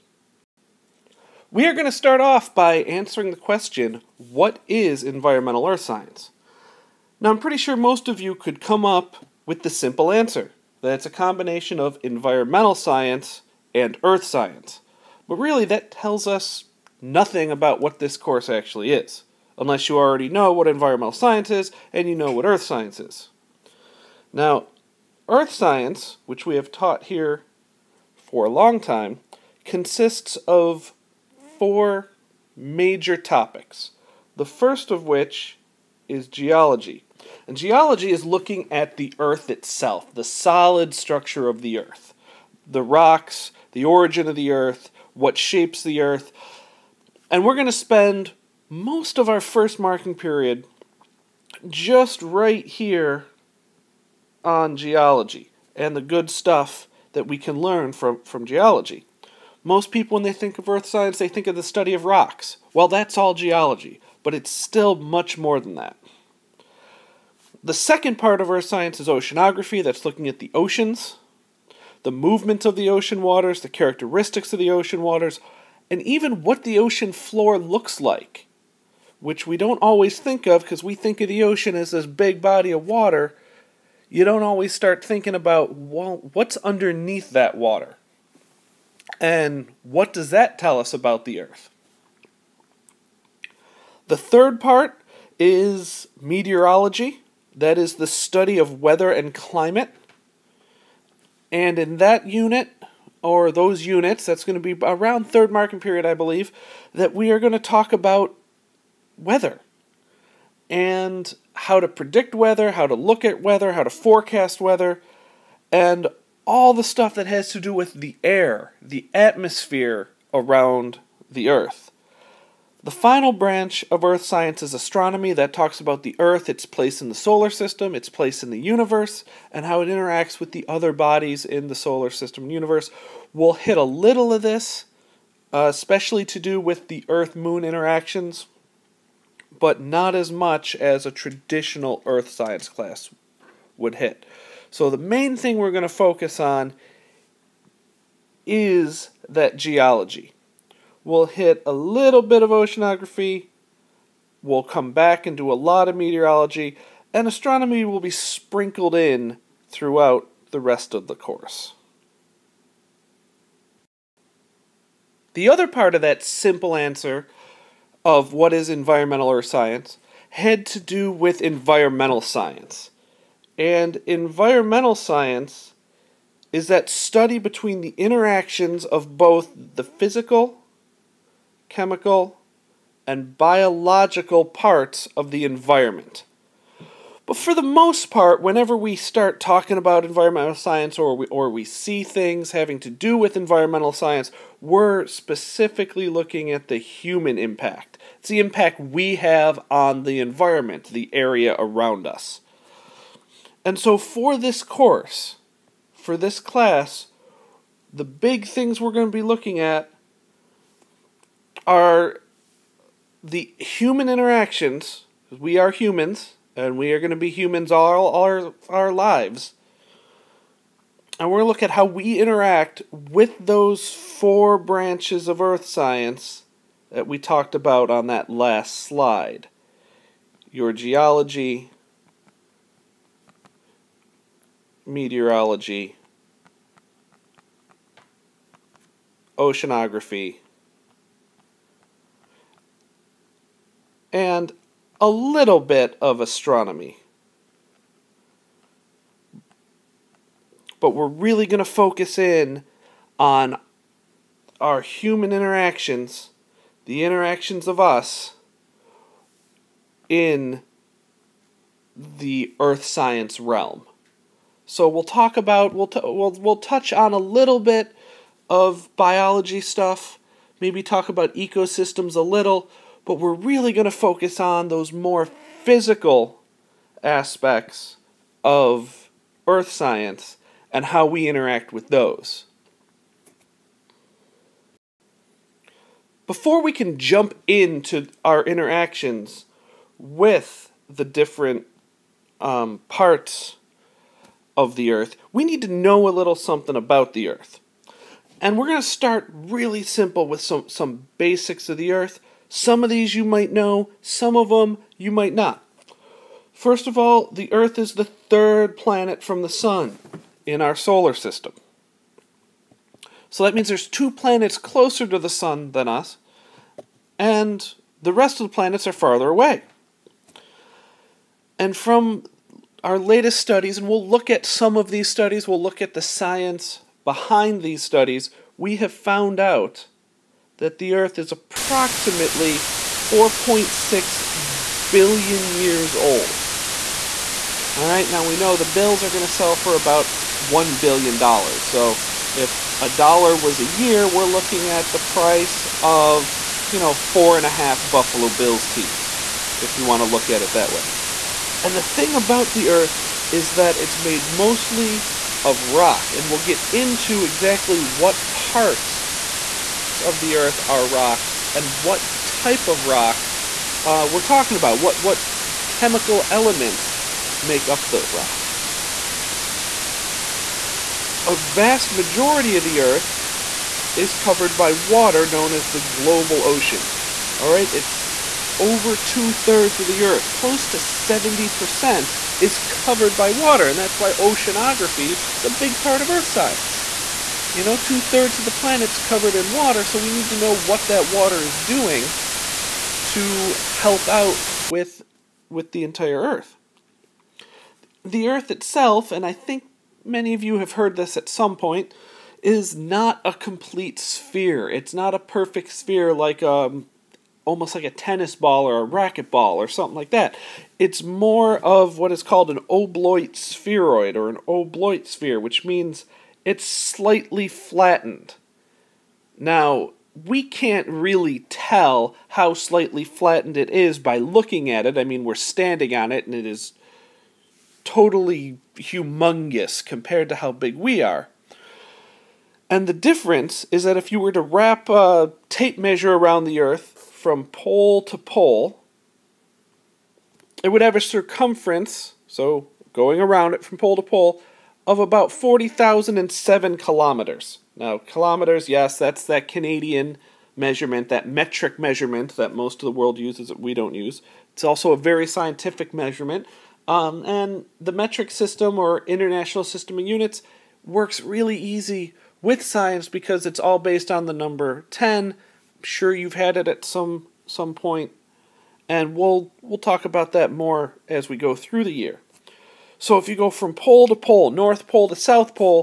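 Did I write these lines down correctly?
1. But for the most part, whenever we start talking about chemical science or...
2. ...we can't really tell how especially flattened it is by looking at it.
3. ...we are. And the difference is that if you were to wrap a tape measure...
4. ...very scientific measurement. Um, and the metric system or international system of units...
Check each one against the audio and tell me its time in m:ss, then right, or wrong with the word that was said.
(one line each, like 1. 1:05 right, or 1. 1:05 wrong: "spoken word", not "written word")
1. 3:07 wrong: "environmental", not "chemical"
2. 7:00 wrong: "slightly", not "especially"
3. 7:10 right
4. 7:34 right.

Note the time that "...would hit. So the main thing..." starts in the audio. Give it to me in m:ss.
2:23.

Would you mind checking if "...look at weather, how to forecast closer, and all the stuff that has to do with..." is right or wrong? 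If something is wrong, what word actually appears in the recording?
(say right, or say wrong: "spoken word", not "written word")
wrong: "weather", not "closer".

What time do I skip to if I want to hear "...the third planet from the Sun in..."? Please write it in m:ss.
5:07.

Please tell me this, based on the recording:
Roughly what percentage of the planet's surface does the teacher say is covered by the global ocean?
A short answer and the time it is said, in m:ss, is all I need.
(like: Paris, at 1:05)
70%, at 6:20.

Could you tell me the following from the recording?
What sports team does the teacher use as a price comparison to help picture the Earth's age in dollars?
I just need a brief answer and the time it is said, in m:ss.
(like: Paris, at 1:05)
Buffalo Bills, at 5:47.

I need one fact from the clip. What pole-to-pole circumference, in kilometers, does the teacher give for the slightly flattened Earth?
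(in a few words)
40,007 kilometers.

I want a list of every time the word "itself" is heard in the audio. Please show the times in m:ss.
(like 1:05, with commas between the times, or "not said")
0:39, 6:38.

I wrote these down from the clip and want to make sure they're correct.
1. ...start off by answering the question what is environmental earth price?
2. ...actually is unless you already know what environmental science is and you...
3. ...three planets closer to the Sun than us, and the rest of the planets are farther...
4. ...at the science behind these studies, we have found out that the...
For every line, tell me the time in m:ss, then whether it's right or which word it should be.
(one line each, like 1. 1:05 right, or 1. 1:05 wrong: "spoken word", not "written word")
1. 0:01 wrong: "science", not "price"
2. 0:18 right
3. 5:13 wrong: "two", not "three"
4. 5:25 right.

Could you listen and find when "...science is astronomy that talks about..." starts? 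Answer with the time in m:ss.
2:04.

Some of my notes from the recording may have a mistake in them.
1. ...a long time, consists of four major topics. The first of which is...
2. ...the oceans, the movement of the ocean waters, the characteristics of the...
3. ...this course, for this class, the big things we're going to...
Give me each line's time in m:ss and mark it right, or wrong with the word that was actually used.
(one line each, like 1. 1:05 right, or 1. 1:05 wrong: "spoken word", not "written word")
1. 0:28 right
2. 1:10 right
3. 3:24 right.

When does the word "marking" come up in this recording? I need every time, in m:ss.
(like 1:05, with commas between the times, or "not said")
0:49, 1:45.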